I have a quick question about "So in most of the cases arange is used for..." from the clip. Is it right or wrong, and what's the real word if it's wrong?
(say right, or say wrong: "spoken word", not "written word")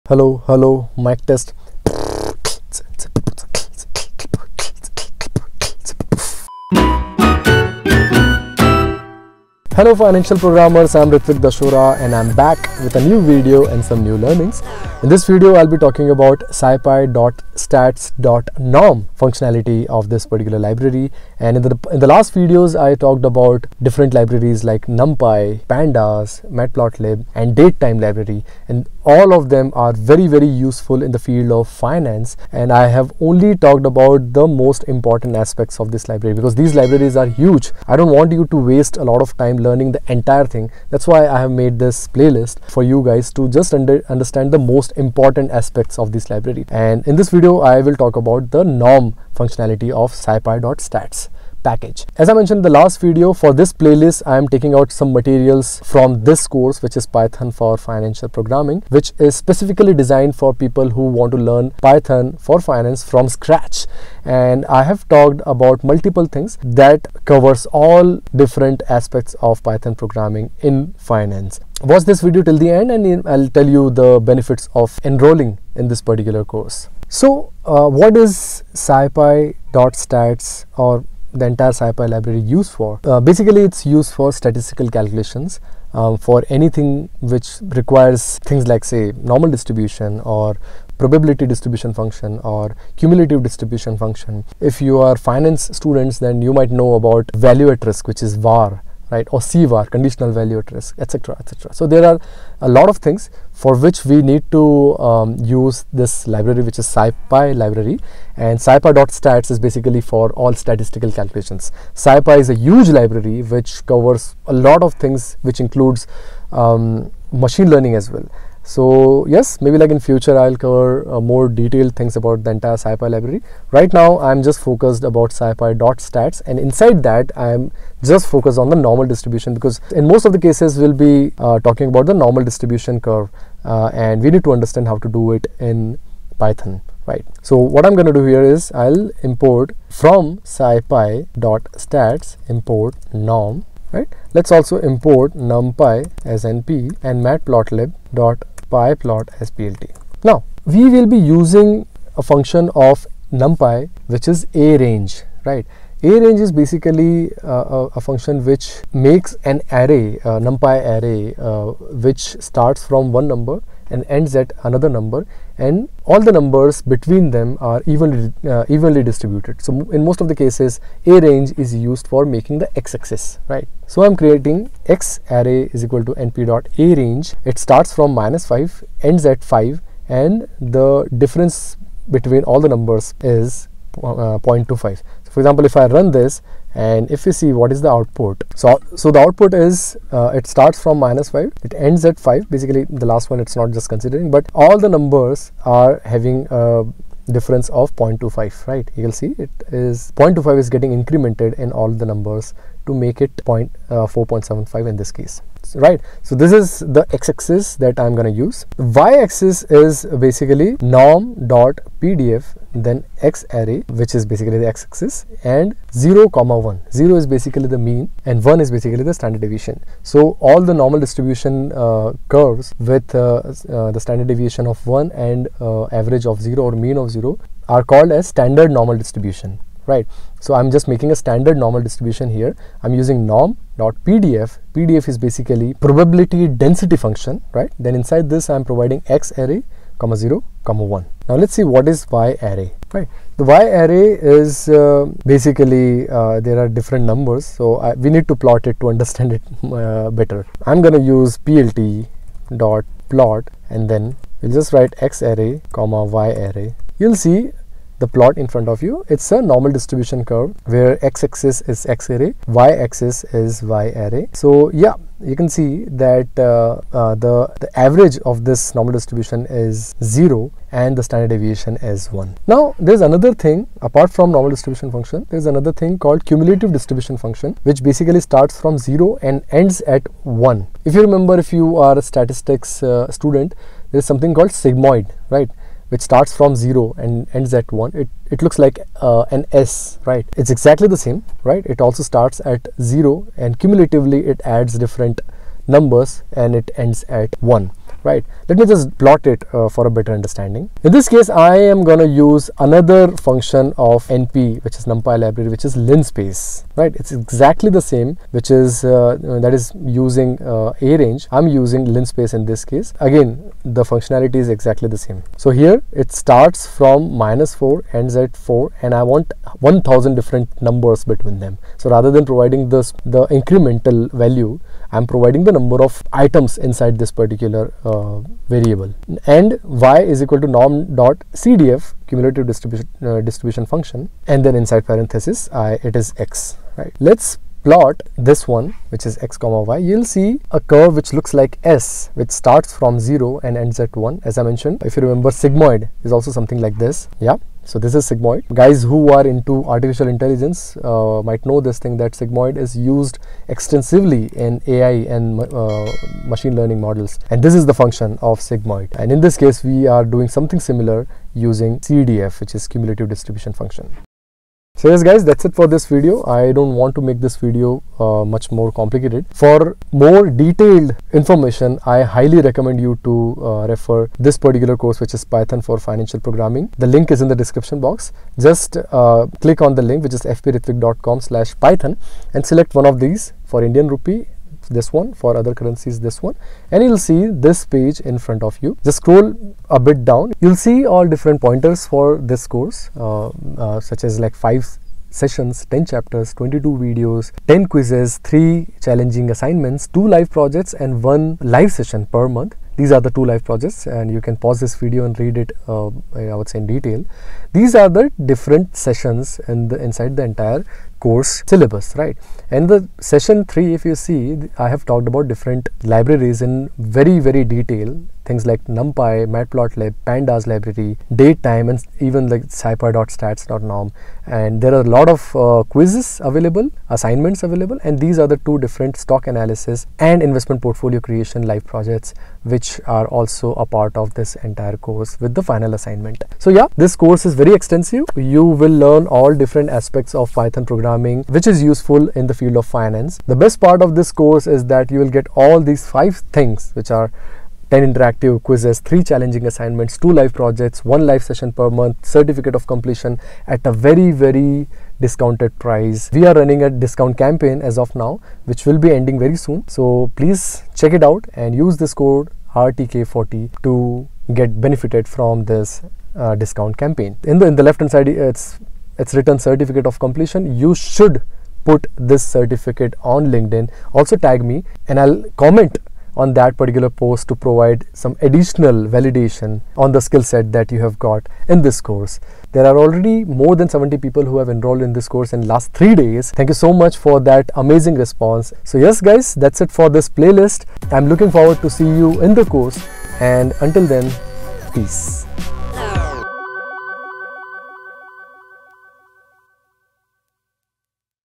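right.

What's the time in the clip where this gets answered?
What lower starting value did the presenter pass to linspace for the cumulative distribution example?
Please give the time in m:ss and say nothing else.
5:17.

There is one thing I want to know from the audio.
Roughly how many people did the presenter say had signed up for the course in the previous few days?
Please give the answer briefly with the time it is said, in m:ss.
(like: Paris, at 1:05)
more than 70, at 8:03.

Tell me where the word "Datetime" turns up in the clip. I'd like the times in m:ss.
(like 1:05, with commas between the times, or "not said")
0:27, 7:01.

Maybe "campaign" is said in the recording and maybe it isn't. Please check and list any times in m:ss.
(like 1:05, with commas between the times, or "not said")
7:37, 7:46.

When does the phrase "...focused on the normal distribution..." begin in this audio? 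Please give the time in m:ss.
2:08.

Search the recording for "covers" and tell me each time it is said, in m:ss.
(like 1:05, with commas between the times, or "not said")
1:07, 1:53, 2:00.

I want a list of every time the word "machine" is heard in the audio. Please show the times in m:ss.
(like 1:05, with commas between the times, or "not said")
1:57, 5:56.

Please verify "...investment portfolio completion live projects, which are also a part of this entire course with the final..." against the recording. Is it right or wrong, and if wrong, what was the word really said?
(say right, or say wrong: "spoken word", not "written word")
wrong: "creation", not "completion".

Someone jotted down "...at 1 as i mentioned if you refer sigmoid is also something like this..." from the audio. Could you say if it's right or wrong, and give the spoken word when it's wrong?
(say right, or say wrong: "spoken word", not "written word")
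wrong: "remember", not "refer".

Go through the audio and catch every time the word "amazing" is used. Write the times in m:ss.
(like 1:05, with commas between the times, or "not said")
8:07.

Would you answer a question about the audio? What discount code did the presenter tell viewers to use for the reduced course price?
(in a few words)
RTK40.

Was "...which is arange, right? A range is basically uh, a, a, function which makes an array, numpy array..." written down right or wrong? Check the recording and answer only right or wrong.
right.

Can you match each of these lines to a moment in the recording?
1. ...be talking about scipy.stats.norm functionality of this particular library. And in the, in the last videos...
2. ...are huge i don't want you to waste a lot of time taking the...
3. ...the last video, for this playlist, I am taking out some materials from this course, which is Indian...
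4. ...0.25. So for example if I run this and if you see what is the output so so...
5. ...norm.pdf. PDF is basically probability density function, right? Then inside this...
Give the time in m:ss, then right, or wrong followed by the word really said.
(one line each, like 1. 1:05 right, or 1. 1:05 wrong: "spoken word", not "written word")
1. 0:15 right
2. 0:37 wrong: "learning", not "taking"
3. 0:52 wrong: "Python", not "Indian"
4. 3:04 right
5. 3:53 right.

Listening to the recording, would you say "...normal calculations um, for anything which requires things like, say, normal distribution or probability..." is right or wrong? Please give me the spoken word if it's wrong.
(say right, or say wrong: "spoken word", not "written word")
wrong: "statistical", not "normal".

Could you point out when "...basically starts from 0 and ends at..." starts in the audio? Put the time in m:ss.
4:37.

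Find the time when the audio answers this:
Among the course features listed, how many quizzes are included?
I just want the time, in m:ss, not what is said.
6:37.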